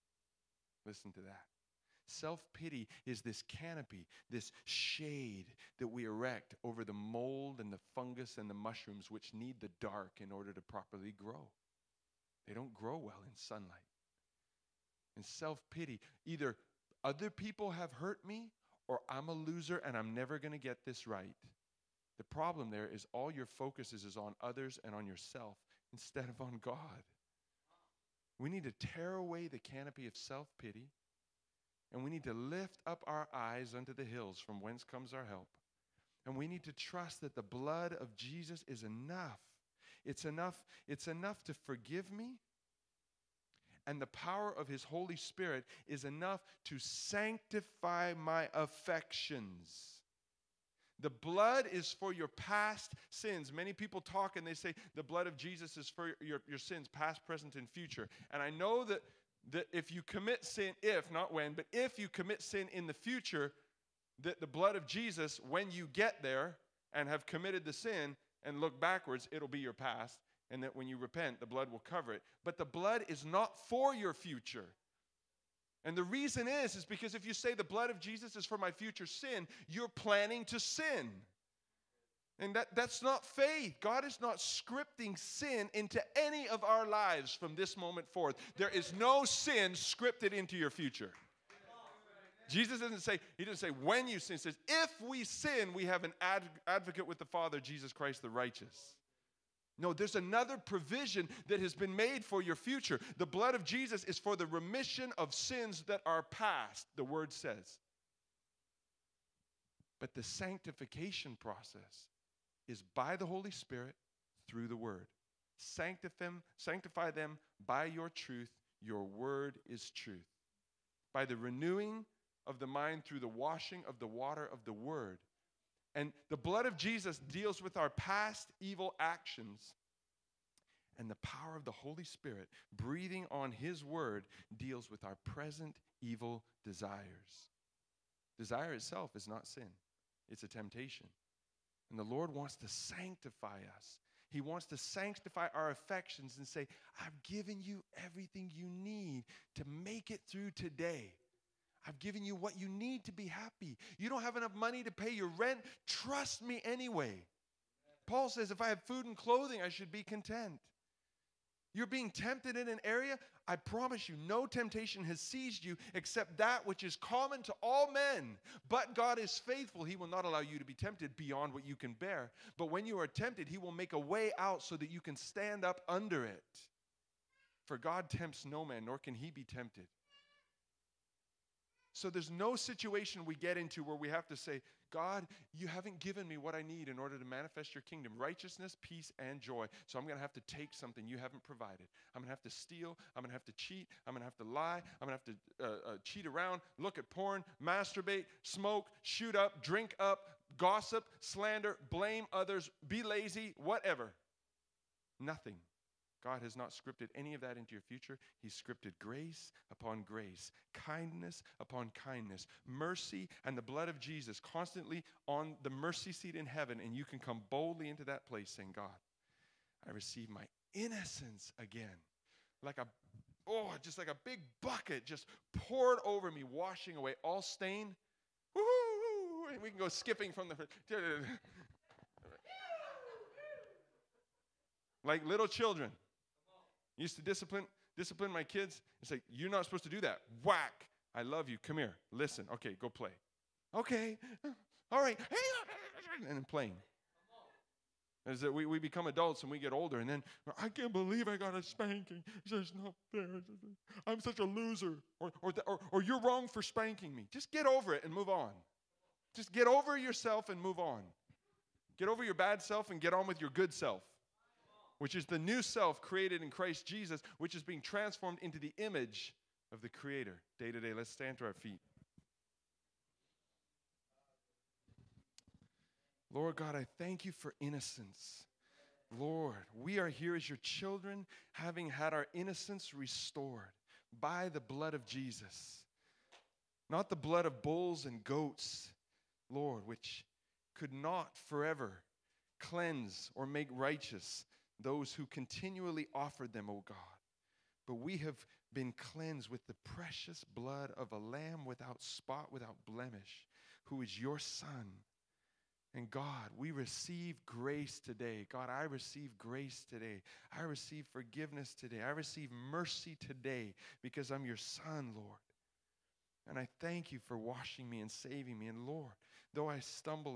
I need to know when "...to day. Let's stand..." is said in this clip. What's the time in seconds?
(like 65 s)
270 s.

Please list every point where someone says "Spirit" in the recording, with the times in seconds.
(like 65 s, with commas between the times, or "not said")
45 s, 113 s, 132 s.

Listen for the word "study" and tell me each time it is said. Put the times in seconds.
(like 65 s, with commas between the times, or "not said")
not said.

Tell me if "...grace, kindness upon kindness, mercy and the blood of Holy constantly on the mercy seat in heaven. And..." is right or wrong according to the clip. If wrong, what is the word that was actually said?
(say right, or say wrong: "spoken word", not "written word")
wrong: "Jesus", not "Holy".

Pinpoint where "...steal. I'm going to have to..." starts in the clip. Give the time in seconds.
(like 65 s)
192 s.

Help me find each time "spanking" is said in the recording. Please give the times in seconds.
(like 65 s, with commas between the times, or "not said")
251 s, 256 s.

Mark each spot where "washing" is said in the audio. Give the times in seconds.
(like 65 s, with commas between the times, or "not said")
123 s, 226 s, 317 s.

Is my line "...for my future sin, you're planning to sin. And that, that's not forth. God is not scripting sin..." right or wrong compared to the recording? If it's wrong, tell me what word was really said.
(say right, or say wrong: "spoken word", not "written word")
wrong: "faith", not "forth".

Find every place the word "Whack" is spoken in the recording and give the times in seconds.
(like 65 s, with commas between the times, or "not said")
240 s.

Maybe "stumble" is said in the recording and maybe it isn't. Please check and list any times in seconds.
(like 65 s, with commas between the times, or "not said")
319 s.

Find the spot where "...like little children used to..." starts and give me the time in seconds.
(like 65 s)
235 s.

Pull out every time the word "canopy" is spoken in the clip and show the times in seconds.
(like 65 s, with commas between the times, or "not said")
3 s, 29 s.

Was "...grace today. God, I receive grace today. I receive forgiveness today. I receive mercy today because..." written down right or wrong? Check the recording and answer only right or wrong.
right.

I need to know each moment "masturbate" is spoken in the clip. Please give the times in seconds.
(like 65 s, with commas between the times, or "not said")
197 s.